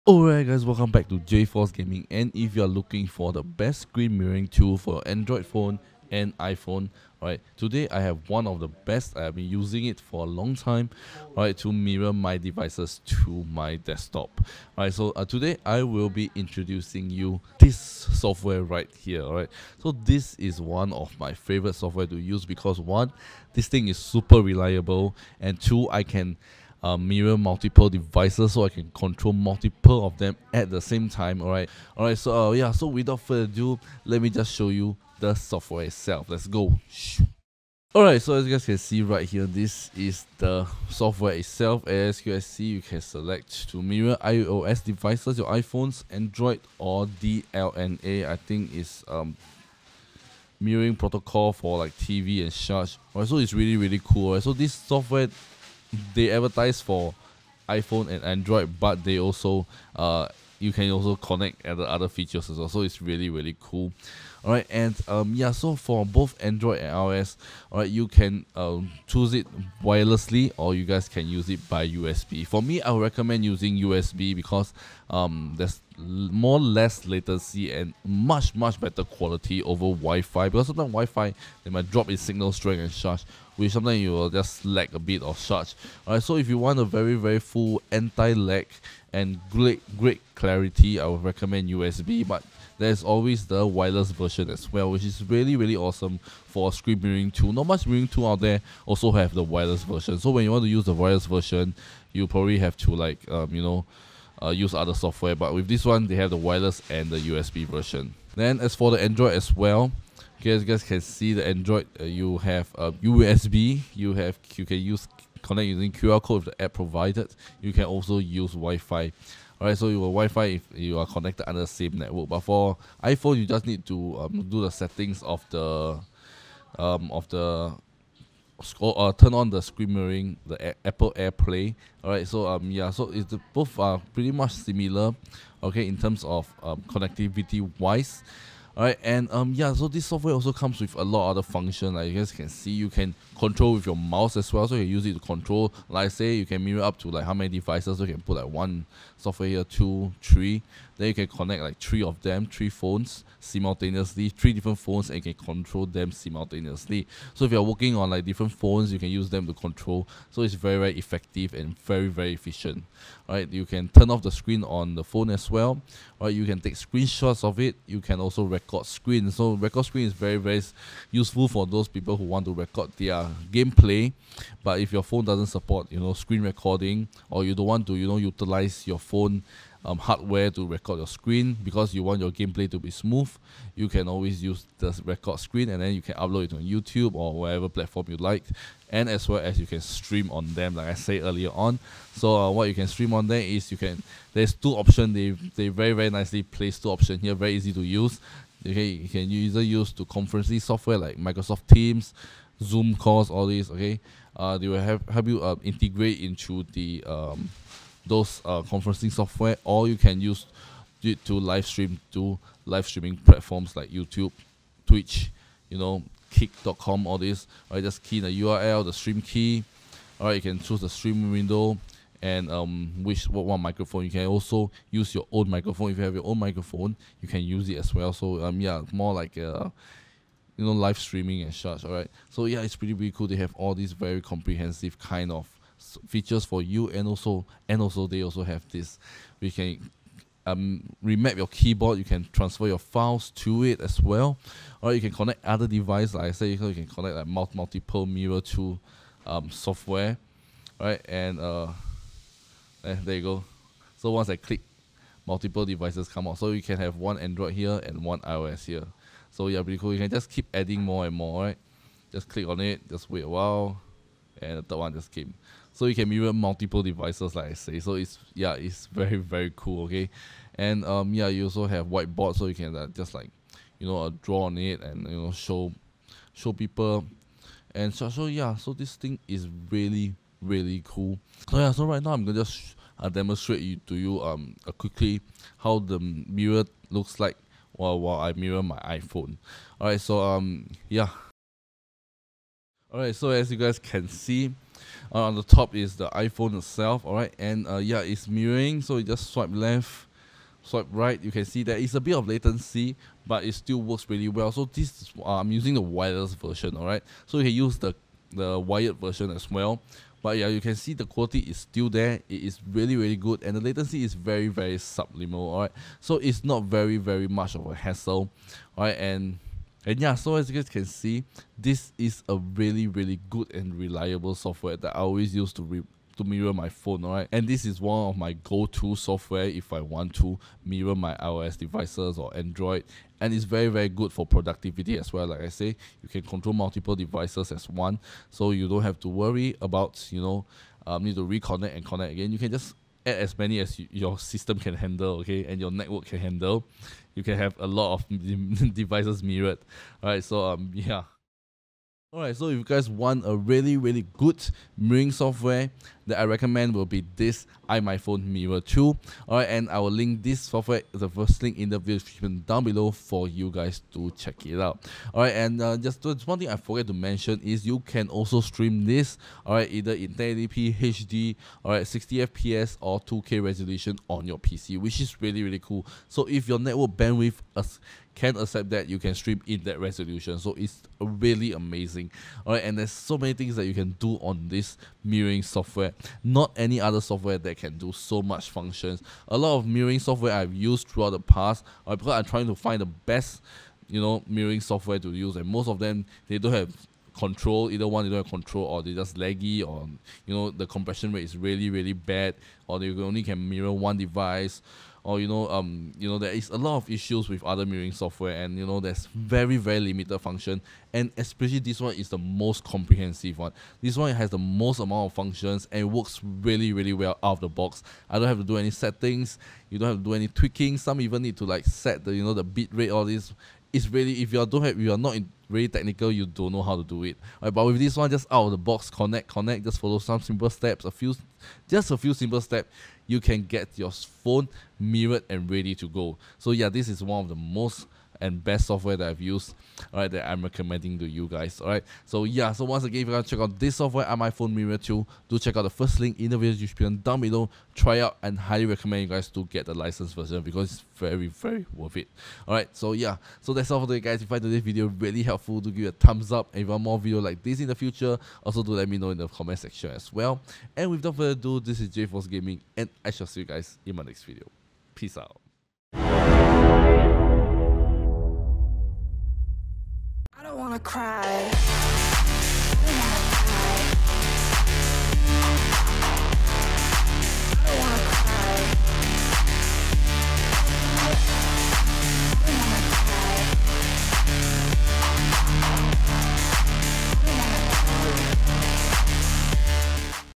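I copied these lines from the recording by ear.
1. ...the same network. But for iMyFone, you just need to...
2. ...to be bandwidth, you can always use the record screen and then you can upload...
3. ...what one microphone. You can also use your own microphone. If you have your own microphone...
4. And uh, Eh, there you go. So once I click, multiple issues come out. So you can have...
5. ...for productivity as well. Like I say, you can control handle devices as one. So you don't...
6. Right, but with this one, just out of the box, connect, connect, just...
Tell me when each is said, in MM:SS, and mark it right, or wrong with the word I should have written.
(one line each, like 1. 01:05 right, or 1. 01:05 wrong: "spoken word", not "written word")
1. 02:01 wrong: "iPhone", not "iMyFone"
2. 03:02 wrong: "smooth", not "bandwidth"
3. 03:43 right
4. 04:11 wrong: "devices", not "issues"
5. 05:34 wrong: "multiple", not "handle"
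6. 07:07 right.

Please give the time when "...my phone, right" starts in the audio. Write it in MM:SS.
05:26.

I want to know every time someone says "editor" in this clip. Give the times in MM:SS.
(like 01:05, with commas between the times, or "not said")
not said.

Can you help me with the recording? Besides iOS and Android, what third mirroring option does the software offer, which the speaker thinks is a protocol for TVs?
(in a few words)
DLNA.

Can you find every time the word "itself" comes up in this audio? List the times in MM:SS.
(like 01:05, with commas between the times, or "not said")
00:35, 00:41, 04:56.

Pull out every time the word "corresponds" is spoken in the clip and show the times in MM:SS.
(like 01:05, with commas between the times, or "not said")
not said.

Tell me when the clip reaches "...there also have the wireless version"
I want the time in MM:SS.
01:38.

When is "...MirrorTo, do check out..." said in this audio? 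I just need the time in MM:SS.
07:24.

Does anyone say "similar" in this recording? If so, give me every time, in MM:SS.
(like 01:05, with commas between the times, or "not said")
02:14.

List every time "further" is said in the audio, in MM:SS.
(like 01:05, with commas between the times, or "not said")
00:33, 07:41.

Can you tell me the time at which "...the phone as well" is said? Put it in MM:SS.
02:44.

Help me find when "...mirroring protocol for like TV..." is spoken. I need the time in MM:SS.
00:50.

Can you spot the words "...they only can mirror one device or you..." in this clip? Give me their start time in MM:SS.
06:42.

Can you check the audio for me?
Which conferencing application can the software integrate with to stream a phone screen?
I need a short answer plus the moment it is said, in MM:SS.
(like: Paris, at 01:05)
Microsoft Teams, at 03:21.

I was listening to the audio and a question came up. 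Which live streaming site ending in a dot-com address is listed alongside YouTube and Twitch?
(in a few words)
Kick.com.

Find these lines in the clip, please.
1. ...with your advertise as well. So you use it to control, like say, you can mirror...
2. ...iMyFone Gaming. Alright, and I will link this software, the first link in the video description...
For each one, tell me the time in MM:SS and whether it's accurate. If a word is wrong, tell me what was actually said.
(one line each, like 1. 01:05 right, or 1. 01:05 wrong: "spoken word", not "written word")
1. 02:23 wrong: "mouse", not "advertise"
2. 05:57 wrong: "MirrorTo", not "Gaming".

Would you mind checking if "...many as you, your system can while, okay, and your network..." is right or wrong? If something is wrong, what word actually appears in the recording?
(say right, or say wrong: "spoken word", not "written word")
wrong: "handle", not "while".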